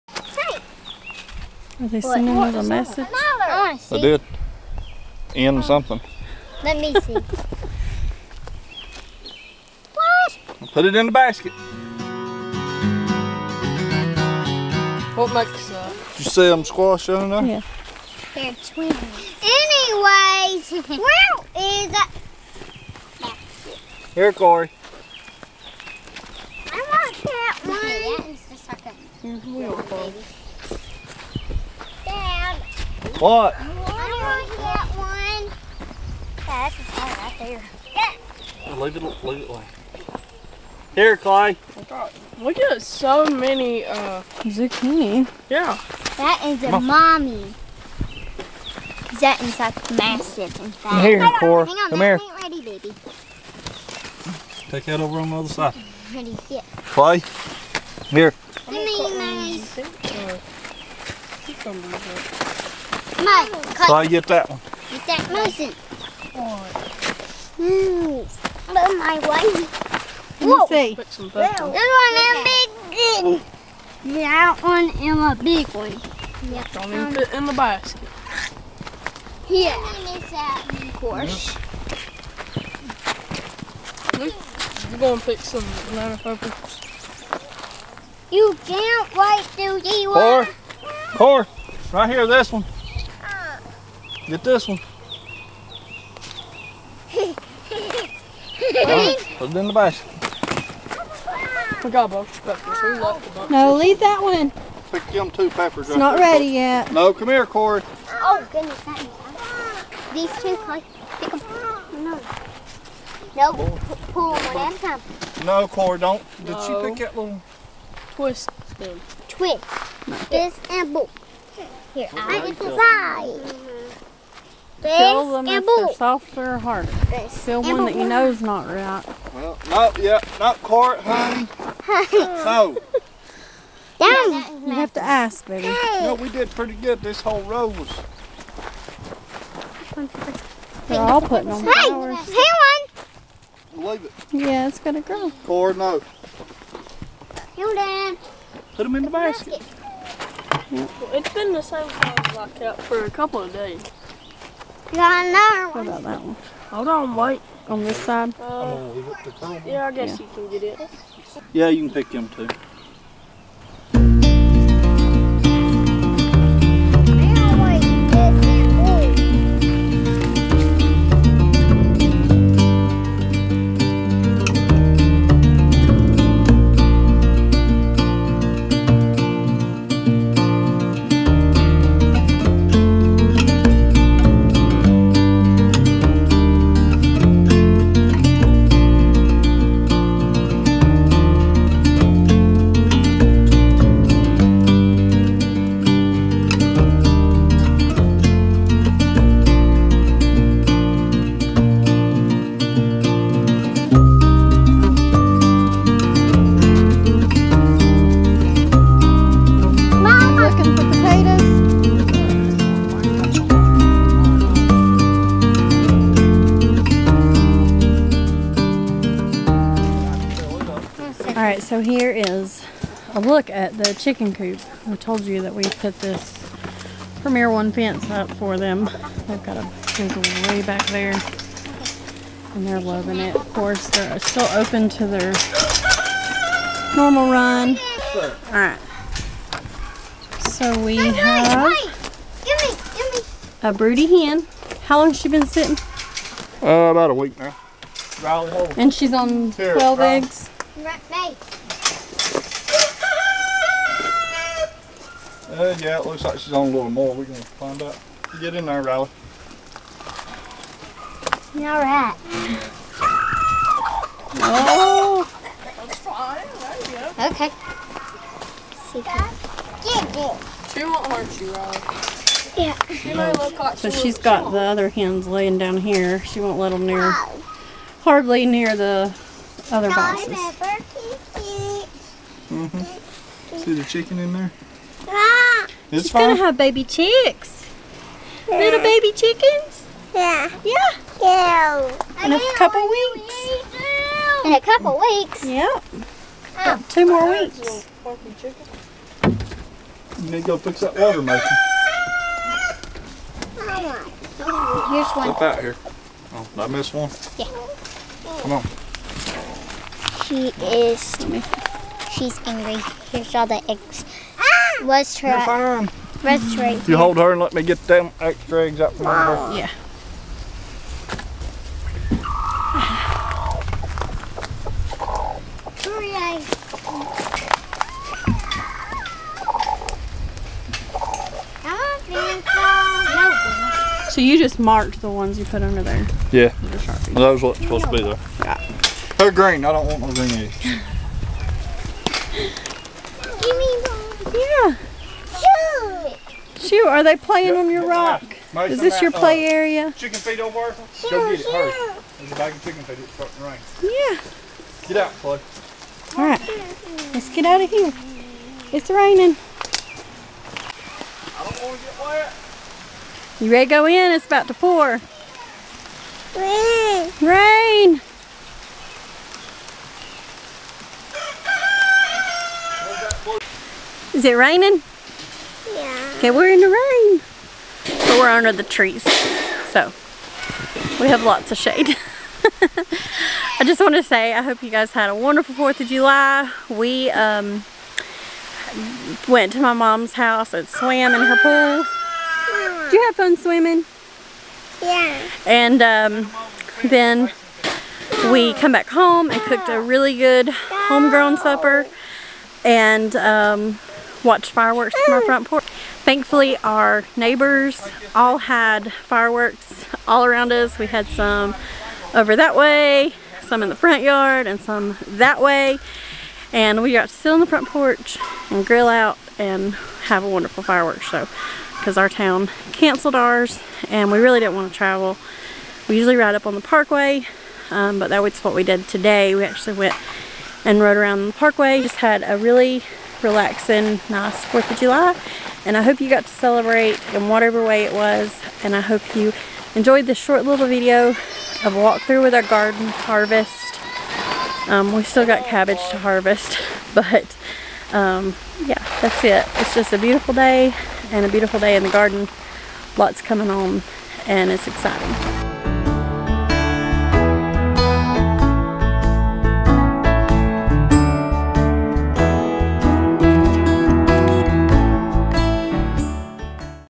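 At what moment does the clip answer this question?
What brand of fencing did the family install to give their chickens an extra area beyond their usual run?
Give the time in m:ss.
3:47.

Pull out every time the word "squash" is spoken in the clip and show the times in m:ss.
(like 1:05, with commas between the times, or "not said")
0:16.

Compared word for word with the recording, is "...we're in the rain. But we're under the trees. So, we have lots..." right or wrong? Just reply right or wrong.
right.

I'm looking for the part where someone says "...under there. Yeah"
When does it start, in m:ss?
5:35.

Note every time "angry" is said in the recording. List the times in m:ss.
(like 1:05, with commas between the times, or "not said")
5:12.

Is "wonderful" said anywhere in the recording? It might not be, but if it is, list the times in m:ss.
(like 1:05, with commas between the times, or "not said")
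6:25, 7:00.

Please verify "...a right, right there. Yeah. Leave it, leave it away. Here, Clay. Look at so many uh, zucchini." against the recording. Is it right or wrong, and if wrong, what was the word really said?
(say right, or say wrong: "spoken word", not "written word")
right.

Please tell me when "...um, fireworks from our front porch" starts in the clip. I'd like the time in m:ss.
6:43.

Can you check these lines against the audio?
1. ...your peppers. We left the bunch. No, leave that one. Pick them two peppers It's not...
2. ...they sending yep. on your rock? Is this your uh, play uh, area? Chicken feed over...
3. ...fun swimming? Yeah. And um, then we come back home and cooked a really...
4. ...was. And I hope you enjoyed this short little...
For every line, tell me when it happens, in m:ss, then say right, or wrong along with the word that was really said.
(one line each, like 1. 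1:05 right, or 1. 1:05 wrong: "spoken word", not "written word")
1. 1:42 right
2. 5:47 wrong: "playing", not "sending"
3. 6:33 right
4. 7:17 right.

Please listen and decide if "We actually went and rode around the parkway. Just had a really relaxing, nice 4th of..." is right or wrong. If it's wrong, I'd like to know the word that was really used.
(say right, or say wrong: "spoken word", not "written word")
right.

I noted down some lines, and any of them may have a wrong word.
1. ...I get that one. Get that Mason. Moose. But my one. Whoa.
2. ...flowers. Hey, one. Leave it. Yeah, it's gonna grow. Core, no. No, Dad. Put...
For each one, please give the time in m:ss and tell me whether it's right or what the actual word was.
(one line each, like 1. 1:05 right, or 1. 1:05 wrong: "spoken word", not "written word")
1. 1:03 right
2. 2:21 right.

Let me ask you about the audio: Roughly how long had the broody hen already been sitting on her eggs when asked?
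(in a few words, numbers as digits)
About a week.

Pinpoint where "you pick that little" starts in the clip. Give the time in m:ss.
1:56.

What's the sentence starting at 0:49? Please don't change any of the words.
That is like massive, in fact.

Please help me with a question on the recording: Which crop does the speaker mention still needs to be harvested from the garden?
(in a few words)
Cabbage.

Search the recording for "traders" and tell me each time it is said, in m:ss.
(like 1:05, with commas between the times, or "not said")
not said.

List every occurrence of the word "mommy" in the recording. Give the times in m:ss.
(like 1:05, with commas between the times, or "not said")
0:46.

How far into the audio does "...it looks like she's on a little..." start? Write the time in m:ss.
4:15.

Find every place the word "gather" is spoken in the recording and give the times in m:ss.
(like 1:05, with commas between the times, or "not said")
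not said.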